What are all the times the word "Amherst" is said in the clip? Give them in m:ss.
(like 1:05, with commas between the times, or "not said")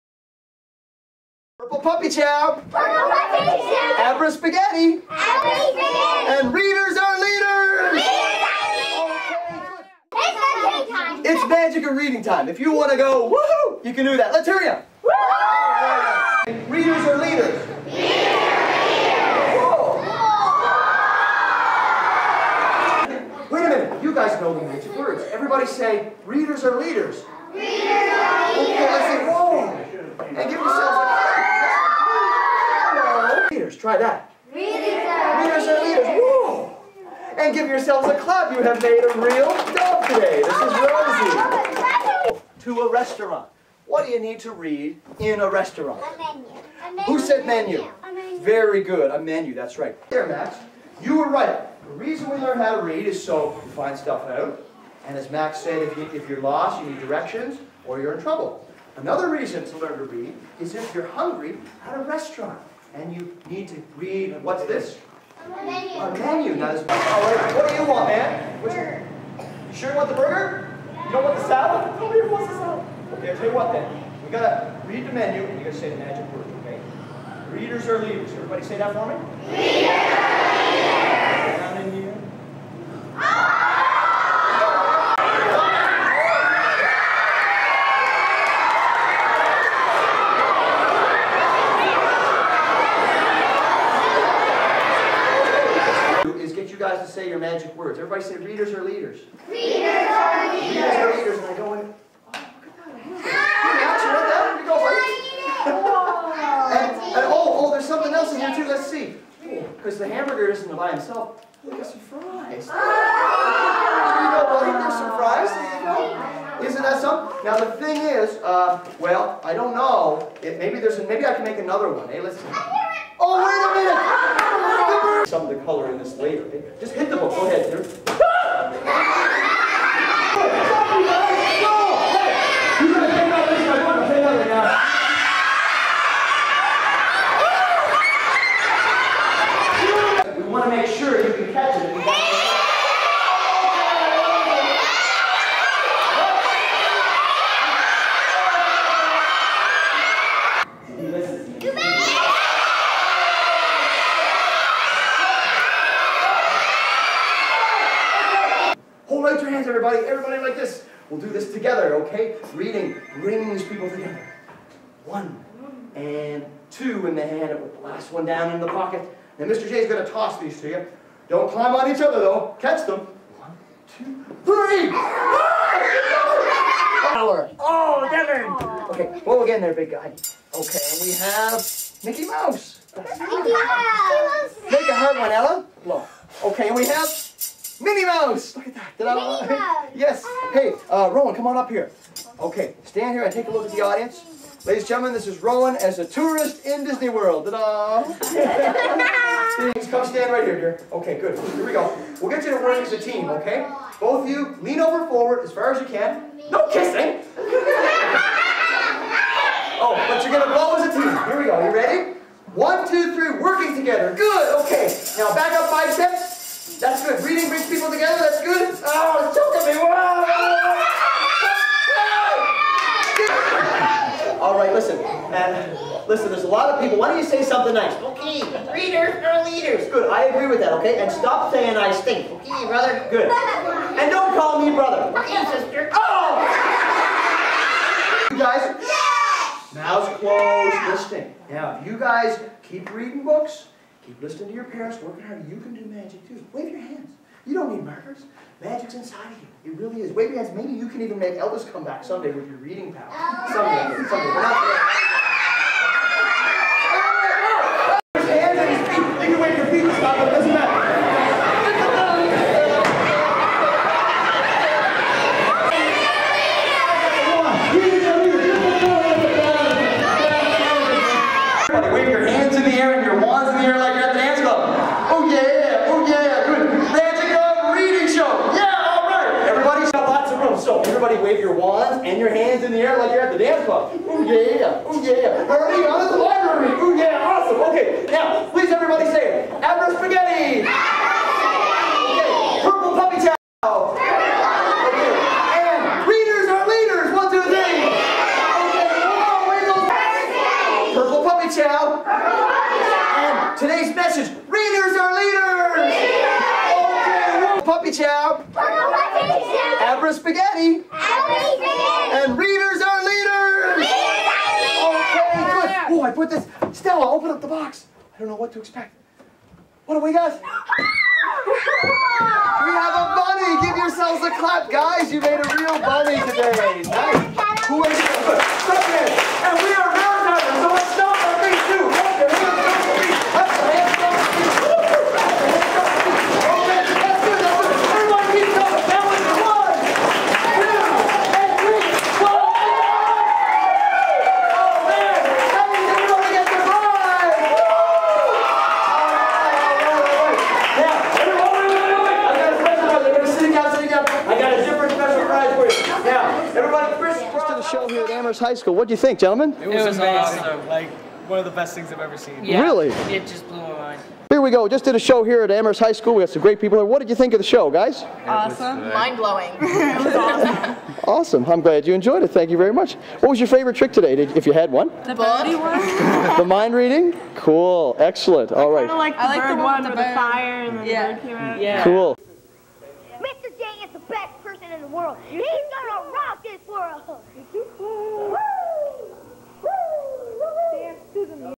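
5:58, 6:05.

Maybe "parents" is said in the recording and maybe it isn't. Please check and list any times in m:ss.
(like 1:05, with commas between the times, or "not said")
4:04.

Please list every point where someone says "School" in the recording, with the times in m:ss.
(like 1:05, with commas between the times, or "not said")
5:58, 6:05.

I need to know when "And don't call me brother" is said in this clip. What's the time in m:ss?
3:53.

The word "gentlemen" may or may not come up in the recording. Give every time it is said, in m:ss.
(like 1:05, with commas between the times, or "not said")
3:14, 5:59.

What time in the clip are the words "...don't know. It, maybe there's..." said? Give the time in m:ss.
1:59.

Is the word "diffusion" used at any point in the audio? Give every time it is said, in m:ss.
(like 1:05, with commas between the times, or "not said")
not said.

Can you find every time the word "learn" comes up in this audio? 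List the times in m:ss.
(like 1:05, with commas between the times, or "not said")
0:52, 0:59.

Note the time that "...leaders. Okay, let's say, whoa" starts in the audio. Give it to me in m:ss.
0:28.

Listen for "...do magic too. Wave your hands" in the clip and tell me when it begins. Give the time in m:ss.
4:05.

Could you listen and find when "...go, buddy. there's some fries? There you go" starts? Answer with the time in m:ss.
1:54.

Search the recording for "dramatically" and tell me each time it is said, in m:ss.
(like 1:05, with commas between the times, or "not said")
not said.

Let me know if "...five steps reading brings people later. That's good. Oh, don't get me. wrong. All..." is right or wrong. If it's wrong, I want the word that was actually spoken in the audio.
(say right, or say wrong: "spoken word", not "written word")
wrong: "together", not "later".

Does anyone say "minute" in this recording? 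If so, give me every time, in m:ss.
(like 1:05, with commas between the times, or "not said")
2:04.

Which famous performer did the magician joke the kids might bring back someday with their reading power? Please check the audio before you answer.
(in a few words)
Elvis.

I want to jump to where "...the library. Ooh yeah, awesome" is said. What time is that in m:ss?
4:46.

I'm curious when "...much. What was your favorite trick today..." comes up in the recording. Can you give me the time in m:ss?
6:12.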